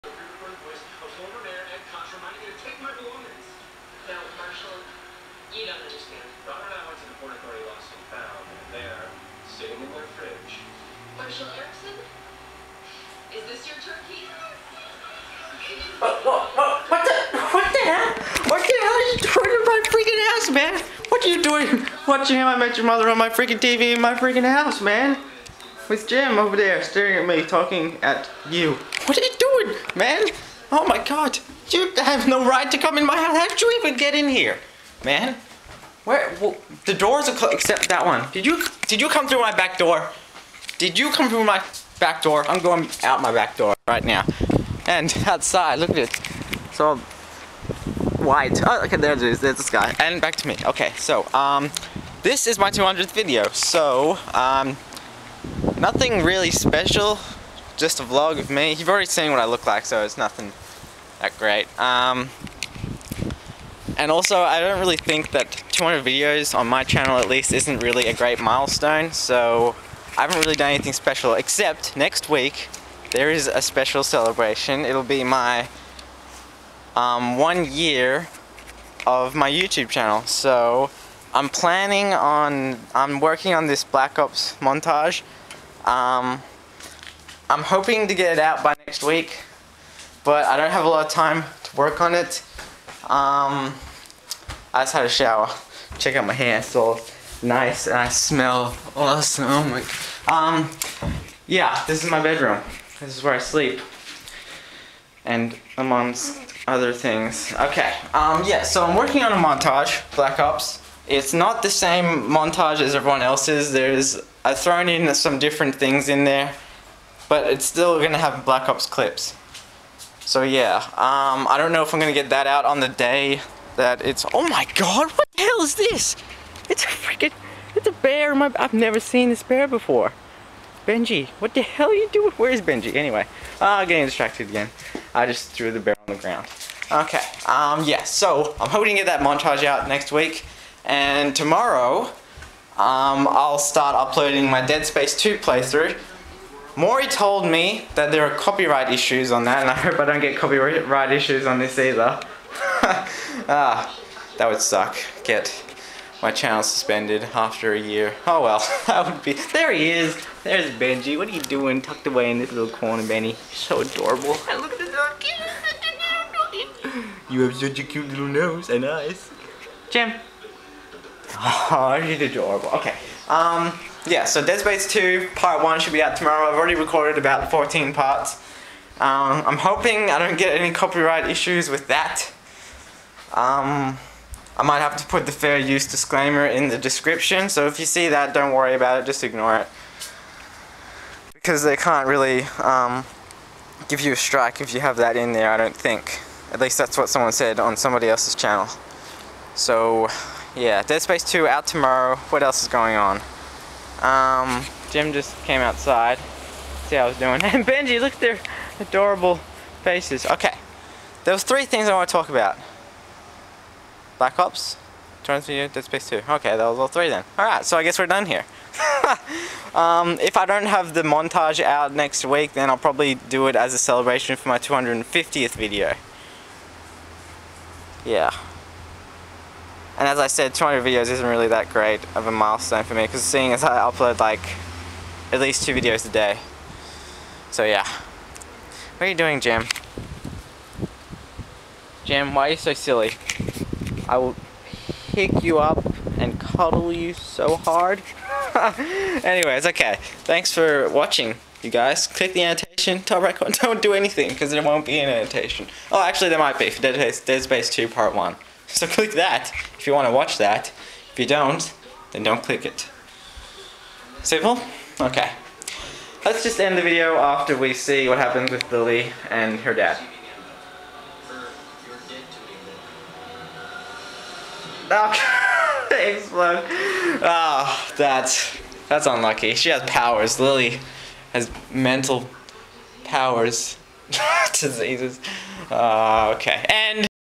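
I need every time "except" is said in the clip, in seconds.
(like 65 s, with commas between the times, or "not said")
37 s, 71 s.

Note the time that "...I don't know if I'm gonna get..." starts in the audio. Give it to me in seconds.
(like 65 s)
121 s.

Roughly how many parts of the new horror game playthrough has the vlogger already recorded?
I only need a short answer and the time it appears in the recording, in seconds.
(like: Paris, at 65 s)
14, at 177 s.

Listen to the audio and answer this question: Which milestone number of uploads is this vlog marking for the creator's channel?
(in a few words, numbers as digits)
200th.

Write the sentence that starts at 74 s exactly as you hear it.
It'll be my um, one year of my YouTube channel.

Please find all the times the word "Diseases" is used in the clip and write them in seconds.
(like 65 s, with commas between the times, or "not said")
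284 s.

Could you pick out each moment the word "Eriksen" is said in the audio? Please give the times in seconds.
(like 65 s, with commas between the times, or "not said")
11 s.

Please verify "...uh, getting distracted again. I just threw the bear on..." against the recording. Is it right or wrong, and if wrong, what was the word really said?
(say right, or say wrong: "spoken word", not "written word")
right.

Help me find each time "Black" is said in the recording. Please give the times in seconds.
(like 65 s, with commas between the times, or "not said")
83 s, 110 s, 118 s, 214 s.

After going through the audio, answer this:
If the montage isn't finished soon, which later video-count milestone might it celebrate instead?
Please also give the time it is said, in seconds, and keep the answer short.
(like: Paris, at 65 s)
250th, at 224 s.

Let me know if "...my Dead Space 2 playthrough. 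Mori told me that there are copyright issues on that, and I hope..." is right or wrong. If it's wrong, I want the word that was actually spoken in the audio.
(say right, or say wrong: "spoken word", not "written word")
right.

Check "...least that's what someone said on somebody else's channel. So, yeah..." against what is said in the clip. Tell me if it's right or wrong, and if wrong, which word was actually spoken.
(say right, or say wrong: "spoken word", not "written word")
right.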